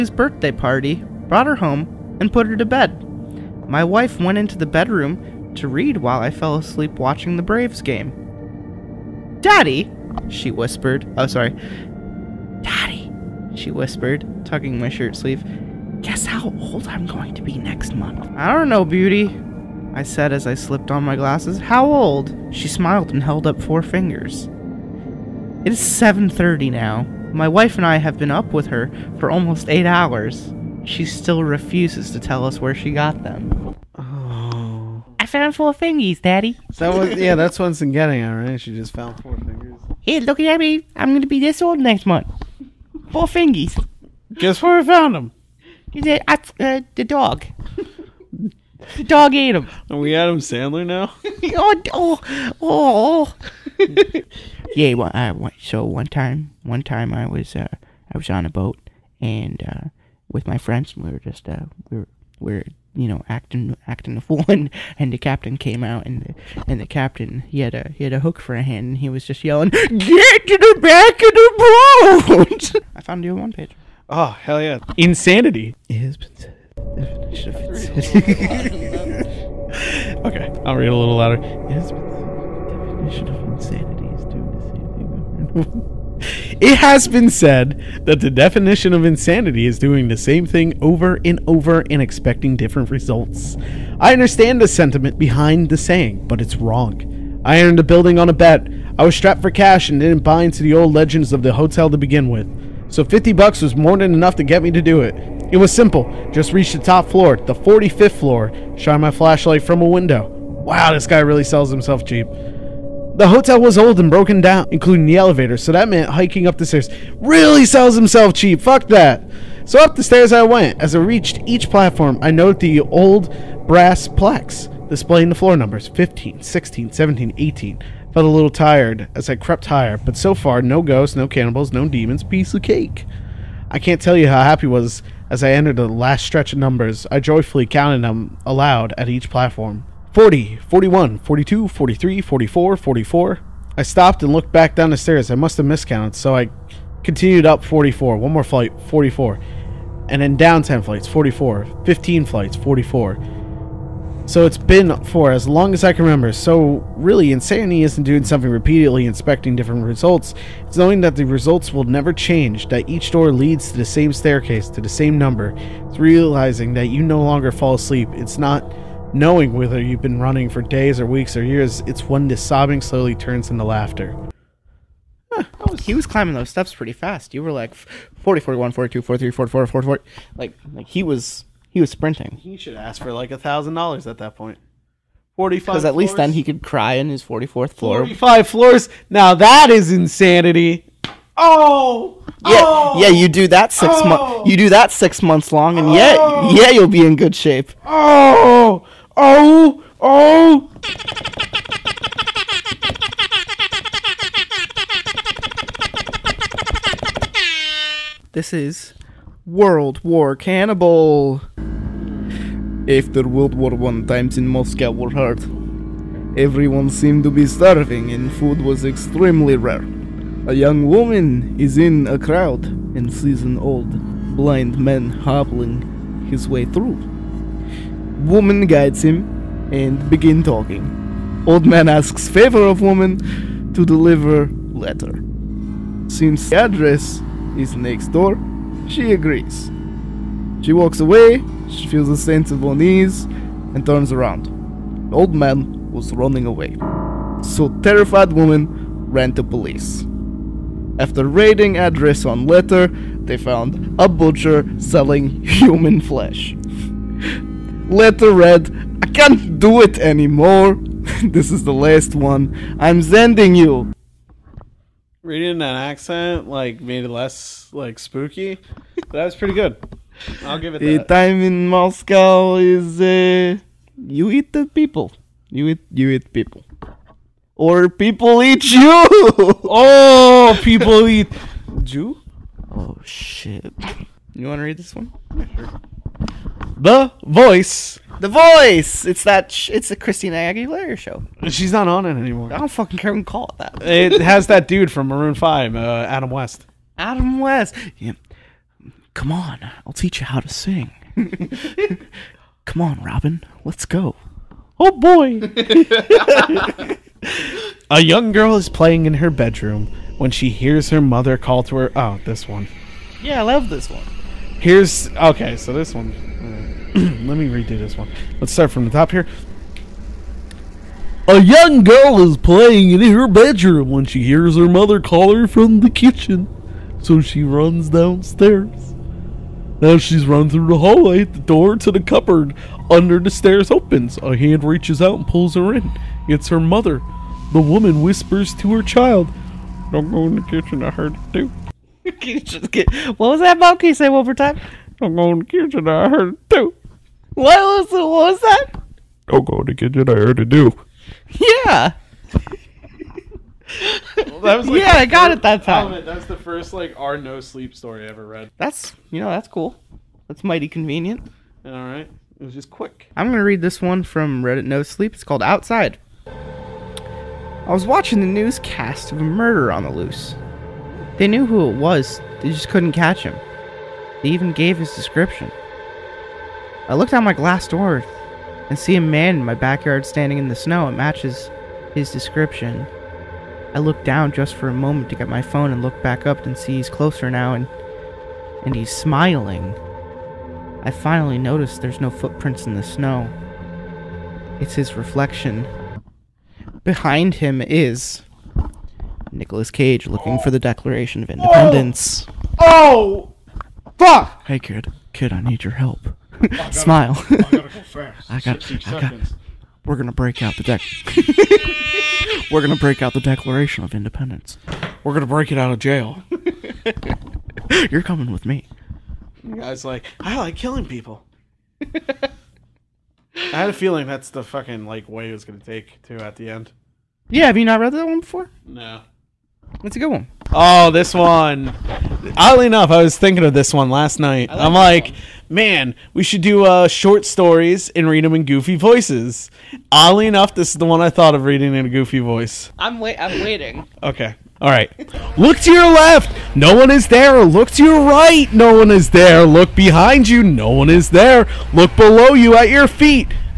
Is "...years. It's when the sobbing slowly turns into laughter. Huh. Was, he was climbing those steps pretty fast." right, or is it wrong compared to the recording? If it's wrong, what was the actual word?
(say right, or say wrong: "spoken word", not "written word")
right.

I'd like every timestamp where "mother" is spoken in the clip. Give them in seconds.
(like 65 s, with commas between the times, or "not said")
310 s, 324 s, 336 s.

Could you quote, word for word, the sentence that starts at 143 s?
I stopped and looked back down the stairs.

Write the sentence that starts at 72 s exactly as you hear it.
I found you on one page.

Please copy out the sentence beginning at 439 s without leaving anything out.
Oddly enough, this is the one I thought of reading in a goofy voice.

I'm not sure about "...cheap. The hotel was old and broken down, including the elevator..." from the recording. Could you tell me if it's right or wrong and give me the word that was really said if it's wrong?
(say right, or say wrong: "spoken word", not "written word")
right.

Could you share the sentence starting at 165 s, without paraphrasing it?
It's realizing that you no longer fall asleep.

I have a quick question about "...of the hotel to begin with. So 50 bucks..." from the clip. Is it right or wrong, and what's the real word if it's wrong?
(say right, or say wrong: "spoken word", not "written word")
right.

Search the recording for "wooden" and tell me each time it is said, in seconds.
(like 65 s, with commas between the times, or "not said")
not said.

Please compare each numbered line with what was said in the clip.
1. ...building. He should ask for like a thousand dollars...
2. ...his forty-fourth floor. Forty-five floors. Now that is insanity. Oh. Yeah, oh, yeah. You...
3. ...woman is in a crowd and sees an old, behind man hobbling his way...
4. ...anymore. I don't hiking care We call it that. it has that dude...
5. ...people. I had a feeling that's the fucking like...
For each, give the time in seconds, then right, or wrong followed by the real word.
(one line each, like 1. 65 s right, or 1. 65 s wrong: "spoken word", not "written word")
1. 181 s wrong: "sprinting", not "building"
2. 187 s right
3. 220 s wrong: "blind", not "behind"
4. 292 s wrong: "fucking", not "hiking"
5. 420 s right.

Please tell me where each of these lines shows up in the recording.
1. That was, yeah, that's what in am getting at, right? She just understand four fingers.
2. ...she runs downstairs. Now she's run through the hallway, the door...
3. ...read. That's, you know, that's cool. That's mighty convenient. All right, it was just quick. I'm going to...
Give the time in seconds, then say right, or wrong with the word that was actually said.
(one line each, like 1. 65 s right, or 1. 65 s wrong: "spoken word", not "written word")
1. 36 s wrong: "found", not "understand"
2. 327 s right
3. 358 s right.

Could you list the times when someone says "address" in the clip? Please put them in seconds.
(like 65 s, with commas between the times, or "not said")
236 s, 251 s.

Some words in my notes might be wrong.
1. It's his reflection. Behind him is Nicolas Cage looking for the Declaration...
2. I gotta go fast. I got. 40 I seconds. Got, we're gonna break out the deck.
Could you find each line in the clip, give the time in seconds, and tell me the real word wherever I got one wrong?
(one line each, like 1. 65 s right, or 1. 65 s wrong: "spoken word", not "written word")
1. 394 s right
2. 407 s wrong: "60", not "40".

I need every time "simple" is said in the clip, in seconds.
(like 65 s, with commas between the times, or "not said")
105 s.